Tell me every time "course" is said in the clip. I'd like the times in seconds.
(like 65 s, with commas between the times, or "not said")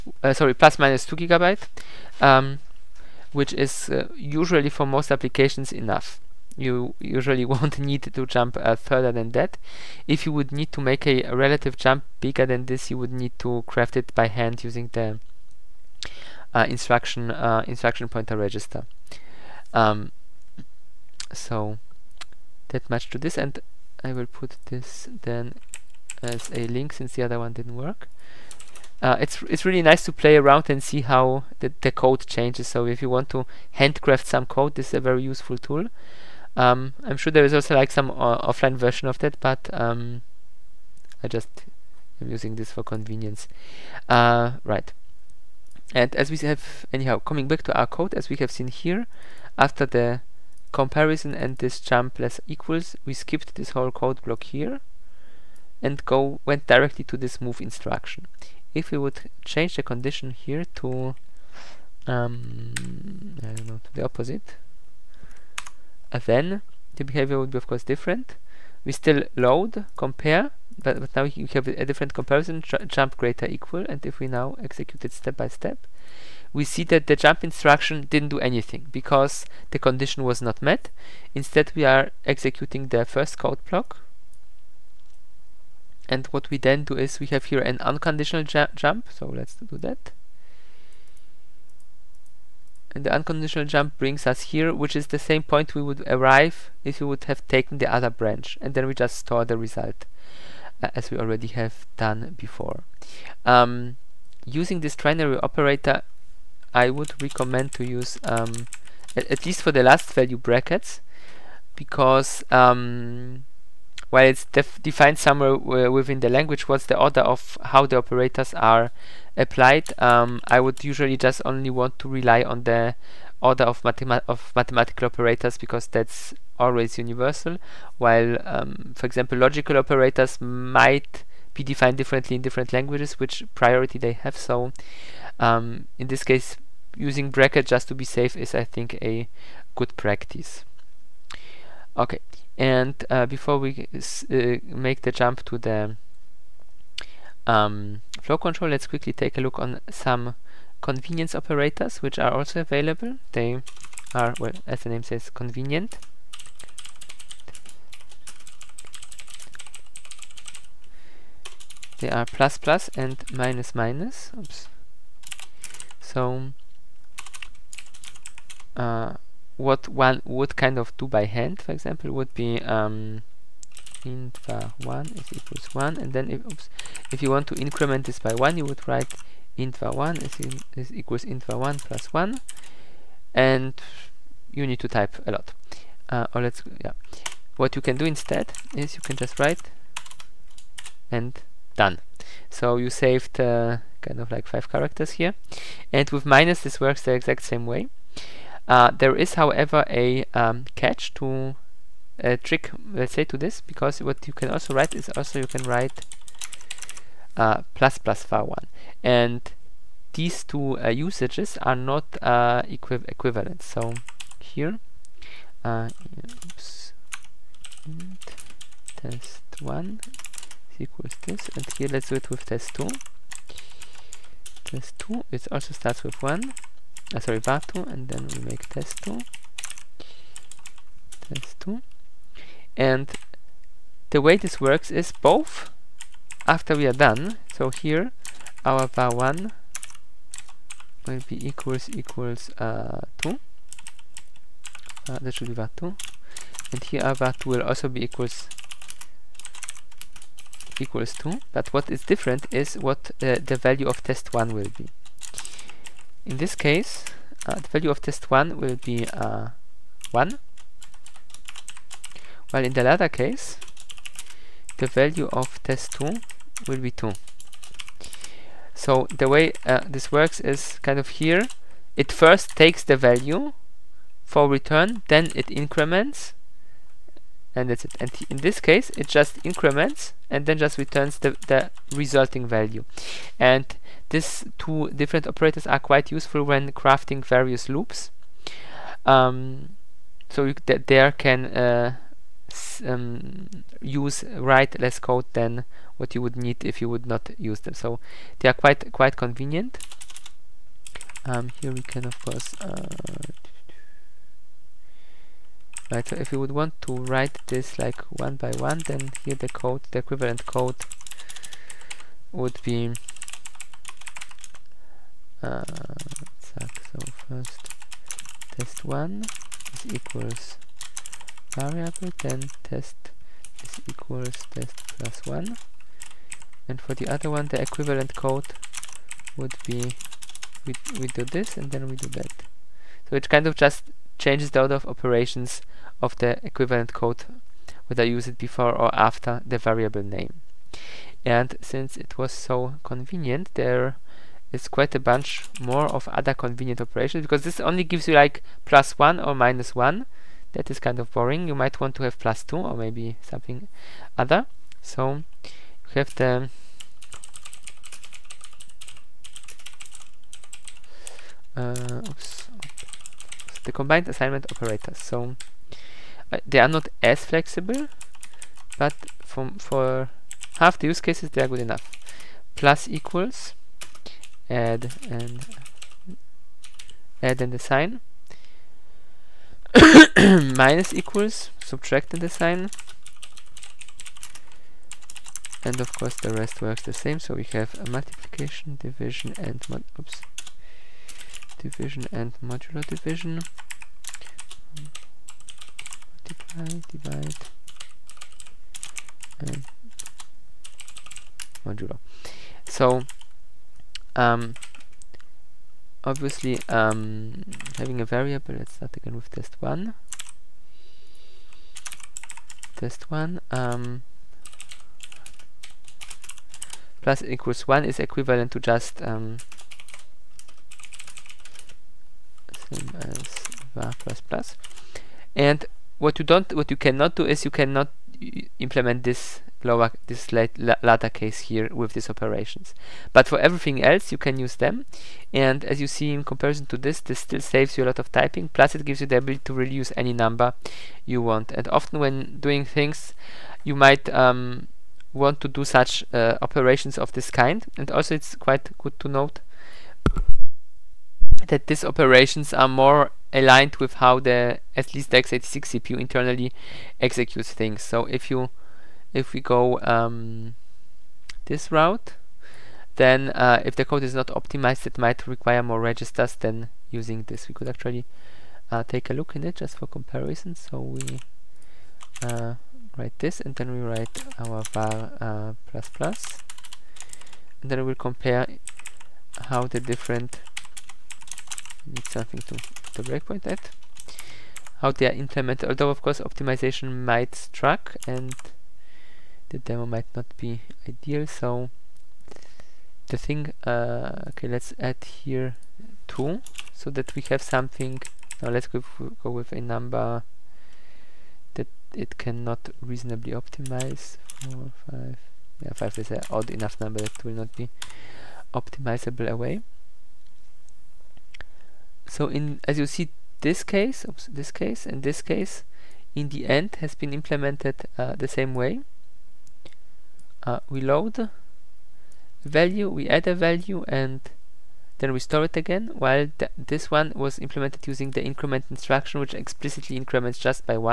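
67 s, 302 s, 385 s, 486 s.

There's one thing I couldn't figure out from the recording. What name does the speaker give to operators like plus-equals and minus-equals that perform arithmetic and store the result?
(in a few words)
combined assignment operators.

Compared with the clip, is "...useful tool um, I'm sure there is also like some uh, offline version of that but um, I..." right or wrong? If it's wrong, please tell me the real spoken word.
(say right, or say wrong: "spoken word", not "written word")
right.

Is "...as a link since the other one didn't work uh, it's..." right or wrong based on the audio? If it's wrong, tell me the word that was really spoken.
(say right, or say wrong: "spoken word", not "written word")
right.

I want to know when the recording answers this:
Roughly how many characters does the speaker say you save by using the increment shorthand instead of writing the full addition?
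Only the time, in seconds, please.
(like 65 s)
194 s.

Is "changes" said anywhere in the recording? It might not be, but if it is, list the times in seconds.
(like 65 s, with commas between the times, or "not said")
32 s, 59 s, 334 s.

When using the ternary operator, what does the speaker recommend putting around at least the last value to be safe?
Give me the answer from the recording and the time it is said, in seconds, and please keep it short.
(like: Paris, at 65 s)
brackets, at 110 s.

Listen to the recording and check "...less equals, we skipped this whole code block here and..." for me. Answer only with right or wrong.
right.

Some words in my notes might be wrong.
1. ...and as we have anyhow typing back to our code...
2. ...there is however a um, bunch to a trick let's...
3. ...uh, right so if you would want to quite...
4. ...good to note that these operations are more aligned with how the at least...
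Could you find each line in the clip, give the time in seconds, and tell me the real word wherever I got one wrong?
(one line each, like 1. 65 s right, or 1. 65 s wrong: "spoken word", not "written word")
1. 45 s wrong: "coming", not "typing"
2. 198 s wrong: "catch", not "bunch"
3. 302 s wrong: "write", not "quite"
4. 448 s right.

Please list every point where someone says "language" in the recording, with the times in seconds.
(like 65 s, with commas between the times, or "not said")
116 s, 132 s.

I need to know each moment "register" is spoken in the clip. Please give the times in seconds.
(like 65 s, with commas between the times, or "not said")
18 s, 465 s.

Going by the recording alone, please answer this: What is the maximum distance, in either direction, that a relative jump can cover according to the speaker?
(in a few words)
plus minus 2 gigabyte.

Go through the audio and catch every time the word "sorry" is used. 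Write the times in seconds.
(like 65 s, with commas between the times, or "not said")
0 s, 227 s.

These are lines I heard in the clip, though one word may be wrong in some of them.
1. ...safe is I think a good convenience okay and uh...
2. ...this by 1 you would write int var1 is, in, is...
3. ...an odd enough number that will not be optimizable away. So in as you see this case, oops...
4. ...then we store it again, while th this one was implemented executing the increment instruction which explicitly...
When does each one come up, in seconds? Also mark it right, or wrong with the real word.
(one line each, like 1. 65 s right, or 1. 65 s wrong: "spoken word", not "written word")
1. 138 s wrong: "practice", not "convenience"
2. 178 s right
3. 506 s right
4. 524 s wrong: "using", not "executing".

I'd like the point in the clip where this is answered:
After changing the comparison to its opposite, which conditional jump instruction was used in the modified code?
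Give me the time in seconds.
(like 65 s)
72 s.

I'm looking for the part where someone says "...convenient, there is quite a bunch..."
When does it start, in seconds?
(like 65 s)
342 s.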